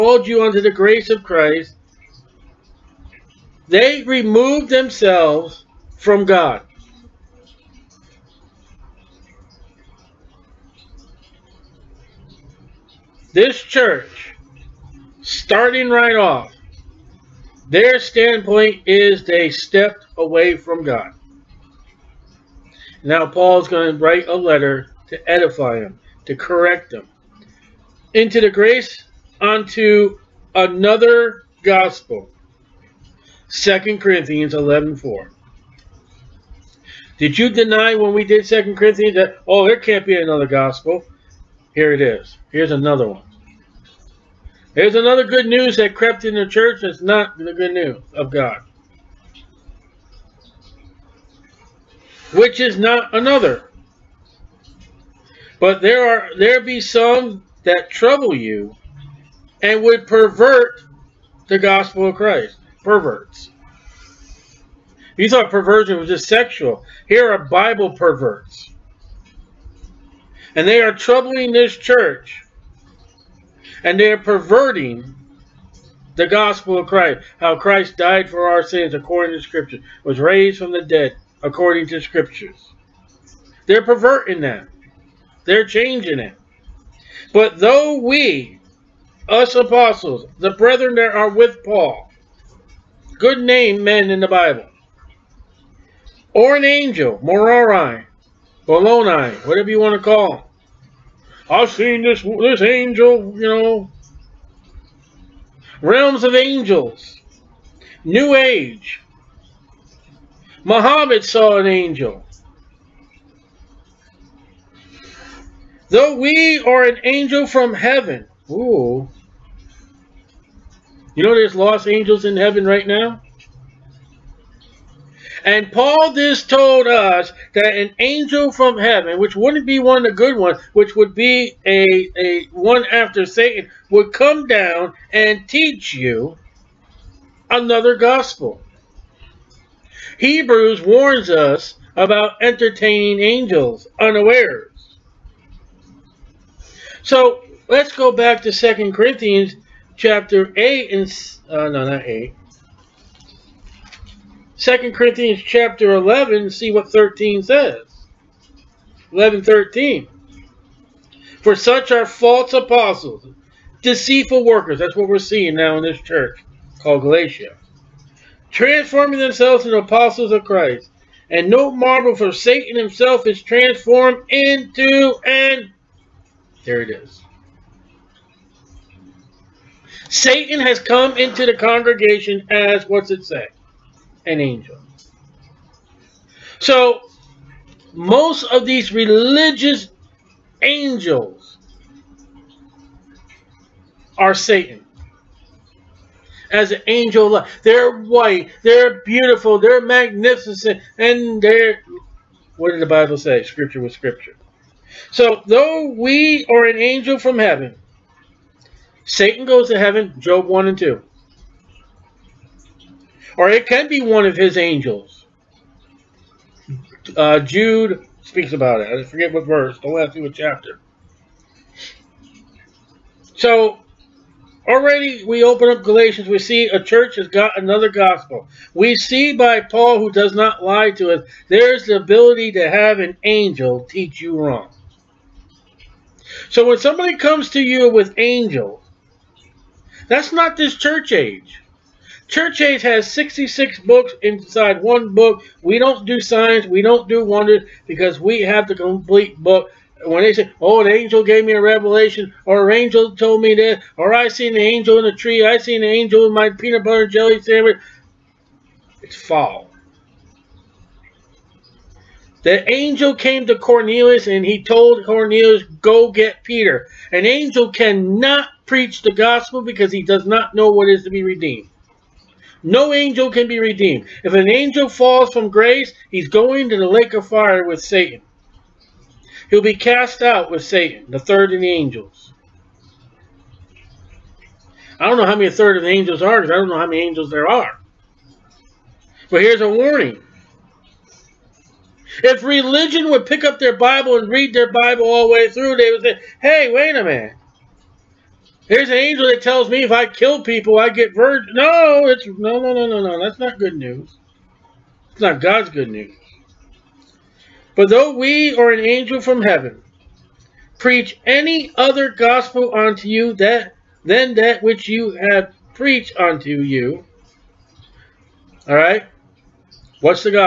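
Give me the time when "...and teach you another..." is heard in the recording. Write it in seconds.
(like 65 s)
135 s.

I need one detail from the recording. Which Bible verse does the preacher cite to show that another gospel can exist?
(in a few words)
2 Corinthians 11:4.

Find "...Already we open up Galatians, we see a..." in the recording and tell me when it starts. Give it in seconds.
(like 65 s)
224 s.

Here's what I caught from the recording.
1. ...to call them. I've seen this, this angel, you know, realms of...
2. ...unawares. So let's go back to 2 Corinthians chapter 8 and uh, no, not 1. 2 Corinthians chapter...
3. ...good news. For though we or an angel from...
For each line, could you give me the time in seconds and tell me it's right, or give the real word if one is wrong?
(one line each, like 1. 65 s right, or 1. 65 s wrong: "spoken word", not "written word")
1. 99 s right
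2. 143 s wrong: "8", not "1"
3. 305 s right.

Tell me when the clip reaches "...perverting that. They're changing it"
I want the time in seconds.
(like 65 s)
83 s.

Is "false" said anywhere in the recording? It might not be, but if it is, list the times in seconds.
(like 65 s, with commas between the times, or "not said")
162 s, 259 s.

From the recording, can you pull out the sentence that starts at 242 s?
Church Age has 66 books inside one book.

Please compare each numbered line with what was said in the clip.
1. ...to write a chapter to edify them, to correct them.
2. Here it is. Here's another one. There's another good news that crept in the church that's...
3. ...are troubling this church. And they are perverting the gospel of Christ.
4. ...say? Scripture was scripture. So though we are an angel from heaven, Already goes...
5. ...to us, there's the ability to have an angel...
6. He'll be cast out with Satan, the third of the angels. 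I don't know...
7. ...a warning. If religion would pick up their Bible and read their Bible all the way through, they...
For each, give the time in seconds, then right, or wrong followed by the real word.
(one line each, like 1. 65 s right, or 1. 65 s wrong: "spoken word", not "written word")
1. 23 s wrong: "letter", not "chapter"
2. 41 s right
3. 70 s right
4. 203 s wrong: "Satan", not "Already"
5. 230 s right
6. 279 s right
7. 289 s right.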